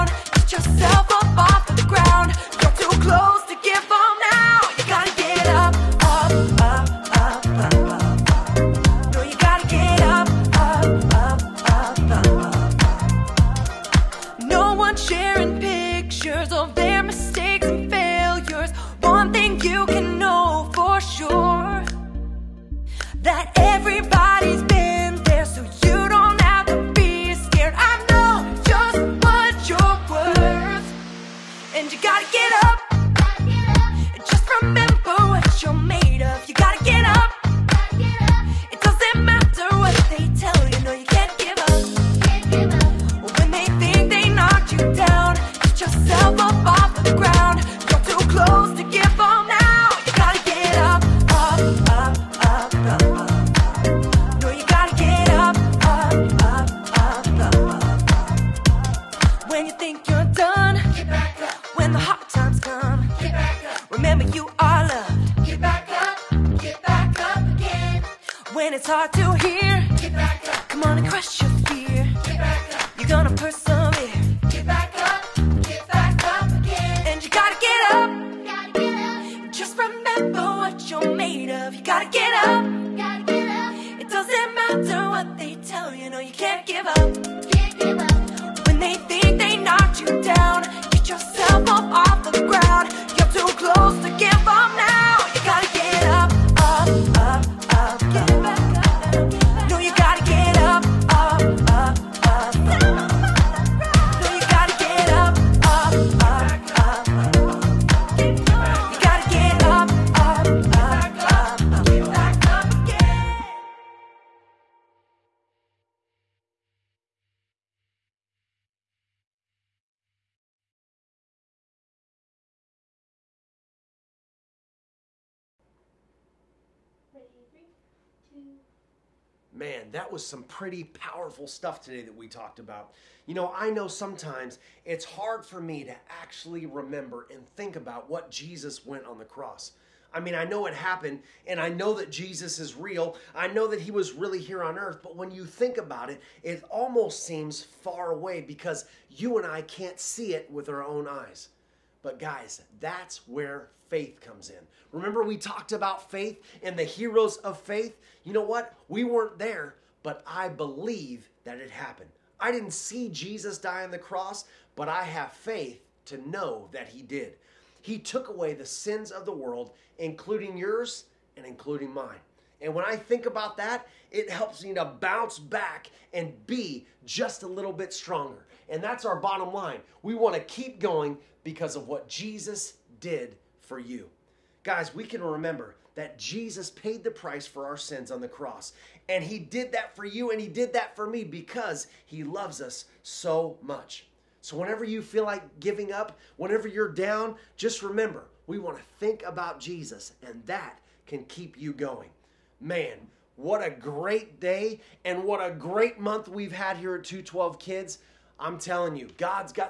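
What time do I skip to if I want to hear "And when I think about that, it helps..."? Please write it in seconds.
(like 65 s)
172 s.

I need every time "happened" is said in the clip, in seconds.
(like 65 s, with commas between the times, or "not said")
140 s, 161 s.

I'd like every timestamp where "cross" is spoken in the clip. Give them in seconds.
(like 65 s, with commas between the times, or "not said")
139 s, 163 s, 188 s.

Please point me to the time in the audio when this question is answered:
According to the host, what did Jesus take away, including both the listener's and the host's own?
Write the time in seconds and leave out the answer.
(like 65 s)
168 s.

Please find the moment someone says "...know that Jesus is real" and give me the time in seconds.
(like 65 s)
141 s.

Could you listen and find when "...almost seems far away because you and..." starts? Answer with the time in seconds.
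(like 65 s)
146 s.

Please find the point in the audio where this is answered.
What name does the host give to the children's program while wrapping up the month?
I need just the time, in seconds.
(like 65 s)
207 s.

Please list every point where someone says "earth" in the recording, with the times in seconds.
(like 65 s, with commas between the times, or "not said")
144 s.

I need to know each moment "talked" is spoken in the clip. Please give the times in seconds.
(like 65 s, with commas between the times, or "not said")
132 s, 155 s.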